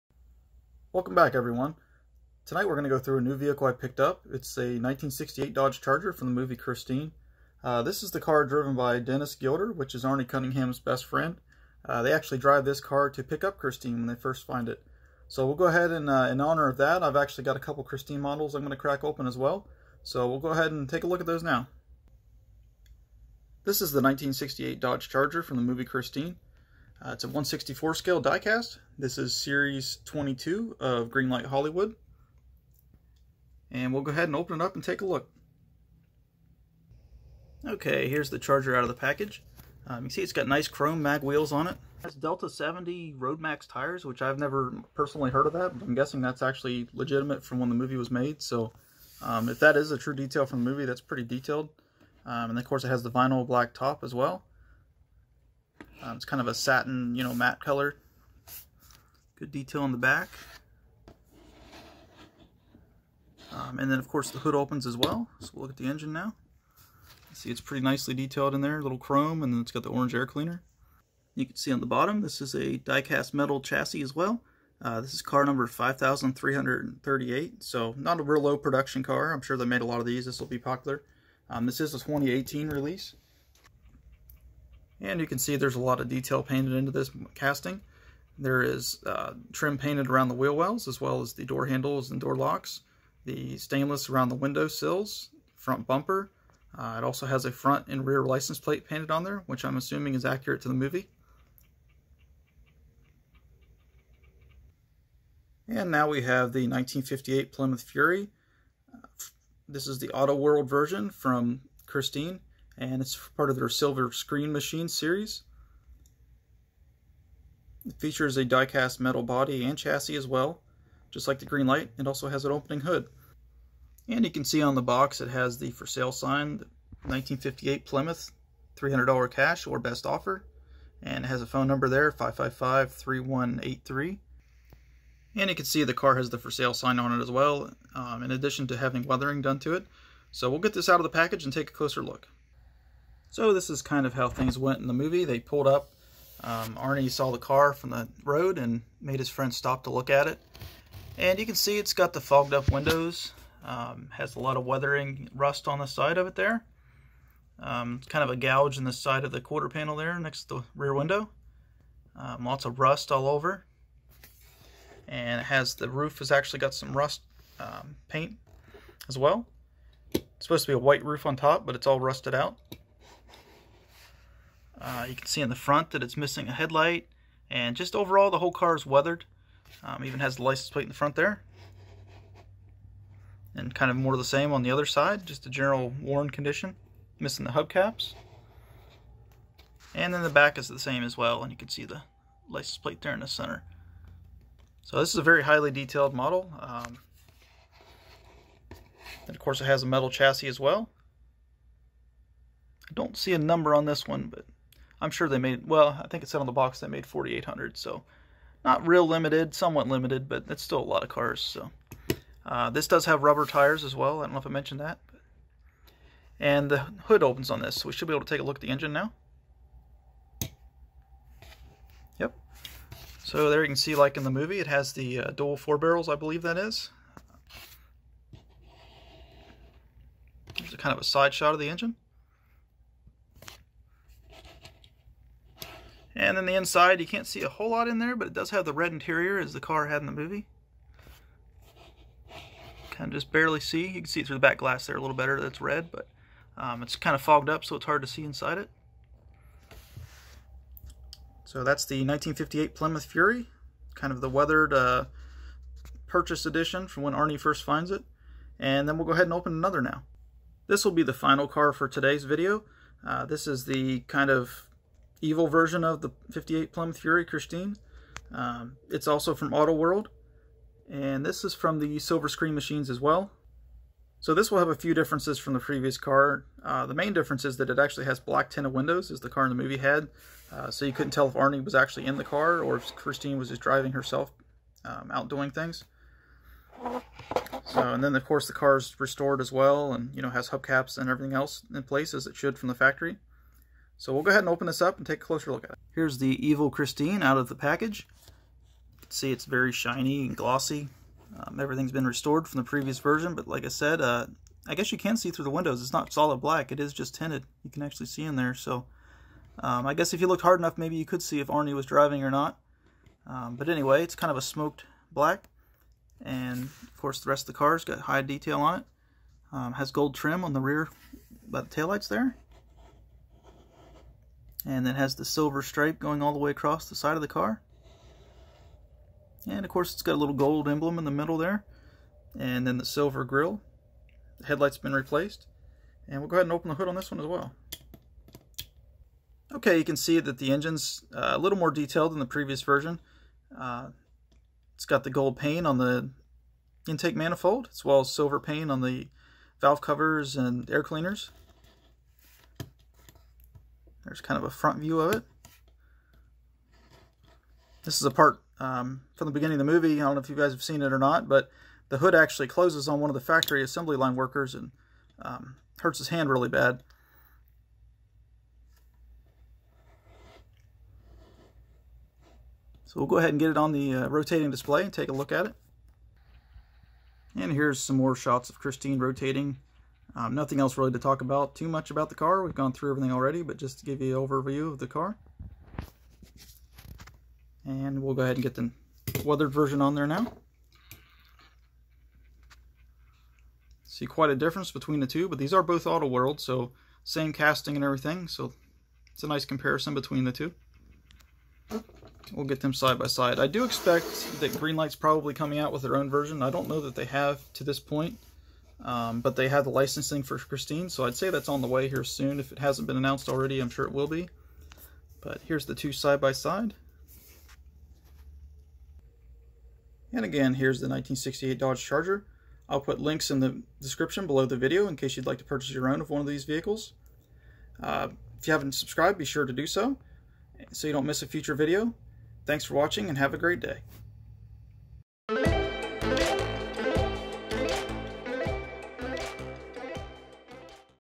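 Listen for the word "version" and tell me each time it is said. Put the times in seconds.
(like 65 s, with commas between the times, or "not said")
110 s, 265 s, 302 s, 342 s, 389 s, 406 s.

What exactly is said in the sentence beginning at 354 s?
There's kind of a front view of it.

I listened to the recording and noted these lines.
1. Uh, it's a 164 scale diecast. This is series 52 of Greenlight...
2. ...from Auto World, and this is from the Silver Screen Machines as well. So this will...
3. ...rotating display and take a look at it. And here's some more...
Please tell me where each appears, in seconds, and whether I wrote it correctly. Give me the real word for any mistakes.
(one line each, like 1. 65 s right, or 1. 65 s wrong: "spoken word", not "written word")
1. 27 s wrong: "22", not "52"
2. 269 s right
3. 374 s right.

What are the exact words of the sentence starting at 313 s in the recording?
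Um, but anyway, it's kind of a smoked black.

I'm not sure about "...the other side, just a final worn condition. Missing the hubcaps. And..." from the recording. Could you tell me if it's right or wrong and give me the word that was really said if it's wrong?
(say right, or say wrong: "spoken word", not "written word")
wrong: "general", not "final".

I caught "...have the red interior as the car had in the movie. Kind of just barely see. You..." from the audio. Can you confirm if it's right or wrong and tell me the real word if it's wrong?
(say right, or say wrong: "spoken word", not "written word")
right.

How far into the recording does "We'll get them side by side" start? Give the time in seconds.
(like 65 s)
402 s.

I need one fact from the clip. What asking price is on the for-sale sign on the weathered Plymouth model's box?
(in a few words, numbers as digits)
$300.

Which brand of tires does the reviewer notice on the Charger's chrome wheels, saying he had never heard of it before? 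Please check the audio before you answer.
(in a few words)
Delta 70 Road Max.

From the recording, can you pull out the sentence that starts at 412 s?
If it hasn't been announced already, I'm sure it will be.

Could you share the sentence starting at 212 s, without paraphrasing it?
Uh, this does have rubber tires as well, I don't know if I mentioned that.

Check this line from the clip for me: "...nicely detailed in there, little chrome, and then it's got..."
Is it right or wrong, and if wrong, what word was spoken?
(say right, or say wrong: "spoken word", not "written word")
right.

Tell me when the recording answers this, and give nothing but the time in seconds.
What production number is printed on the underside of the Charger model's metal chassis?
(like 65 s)
75 s.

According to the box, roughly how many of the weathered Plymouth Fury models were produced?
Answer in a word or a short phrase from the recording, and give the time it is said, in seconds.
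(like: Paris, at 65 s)
4,800, at 207 s.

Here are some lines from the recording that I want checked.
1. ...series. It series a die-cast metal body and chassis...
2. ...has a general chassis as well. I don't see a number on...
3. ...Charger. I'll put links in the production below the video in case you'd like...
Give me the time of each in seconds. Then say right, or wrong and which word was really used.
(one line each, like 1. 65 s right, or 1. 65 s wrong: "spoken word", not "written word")
1. 114 s wrong: "features", not "series"
2. 199 s wrong: "metal", not "general"
3. 421 s wrong: "description", not "production".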